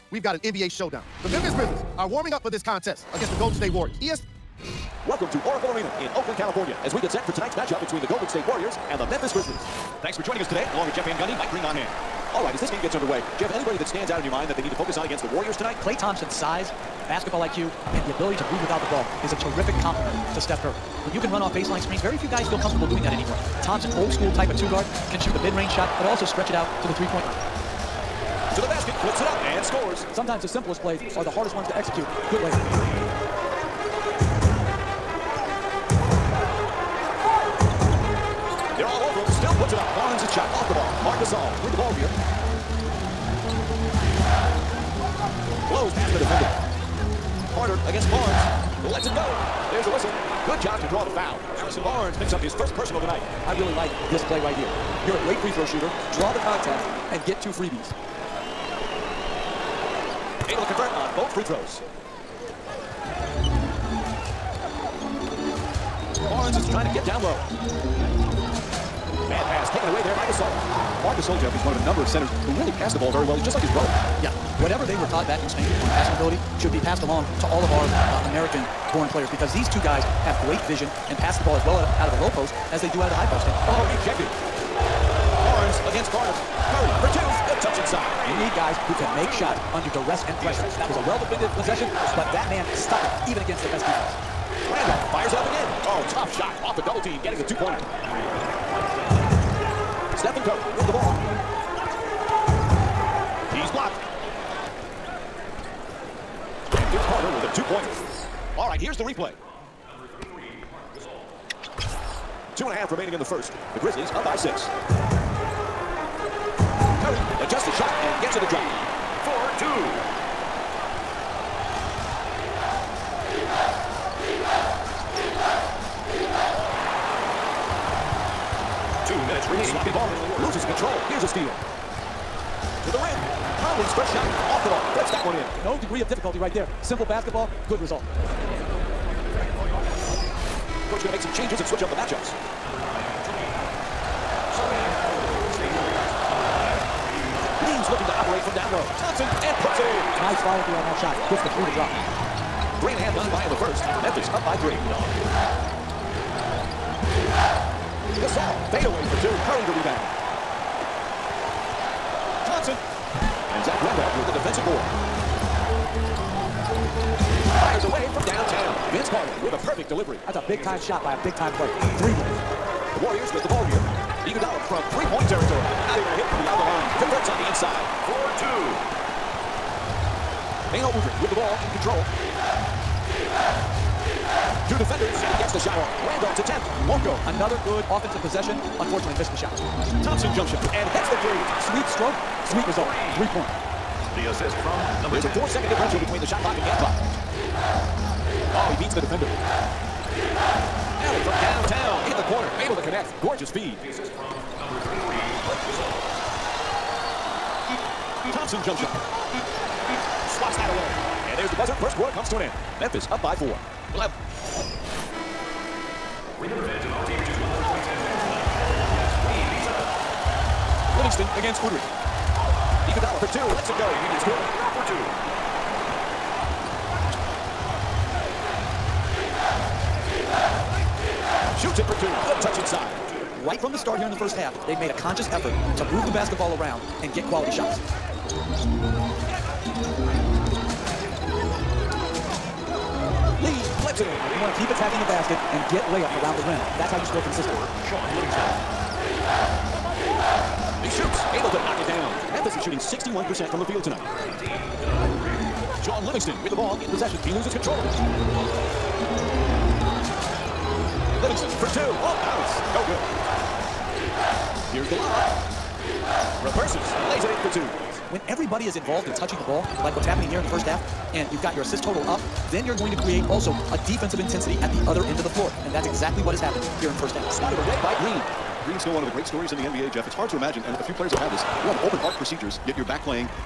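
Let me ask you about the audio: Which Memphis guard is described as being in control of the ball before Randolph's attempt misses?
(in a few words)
Beno Udrih.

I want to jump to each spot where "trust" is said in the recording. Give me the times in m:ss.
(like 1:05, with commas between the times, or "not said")
not said.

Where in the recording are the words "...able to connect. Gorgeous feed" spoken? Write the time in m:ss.
3:22.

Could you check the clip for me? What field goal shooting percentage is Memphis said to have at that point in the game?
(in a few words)
61%.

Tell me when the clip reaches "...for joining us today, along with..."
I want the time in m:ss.
0:10.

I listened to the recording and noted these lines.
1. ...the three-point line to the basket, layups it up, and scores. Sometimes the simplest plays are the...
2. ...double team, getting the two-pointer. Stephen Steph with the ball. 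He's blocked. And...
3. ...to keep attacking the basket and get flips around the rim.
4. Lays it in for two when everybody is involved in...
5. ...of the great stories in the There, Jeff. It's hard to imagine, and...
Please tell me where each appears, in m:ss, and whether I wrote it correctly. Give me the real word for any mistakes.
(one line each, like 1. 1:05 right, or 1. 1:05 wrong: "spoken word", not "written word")
1. 0:26 wrong: "flips", not "layups"
2. 1:36 wrong: "Curry", not "Steph"
3. 4:04 wrong: "layups", not "flips"
4. 4:27 right
5. 4:39 wrong: "NBA", not "There".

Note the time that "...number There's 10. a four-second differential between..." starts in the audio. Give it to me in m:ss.
3:15.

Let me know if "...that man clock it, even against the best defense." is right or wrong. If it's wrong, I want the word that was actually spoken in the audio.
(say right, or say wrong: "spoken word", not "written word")
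wrong: "stuck", not "clock".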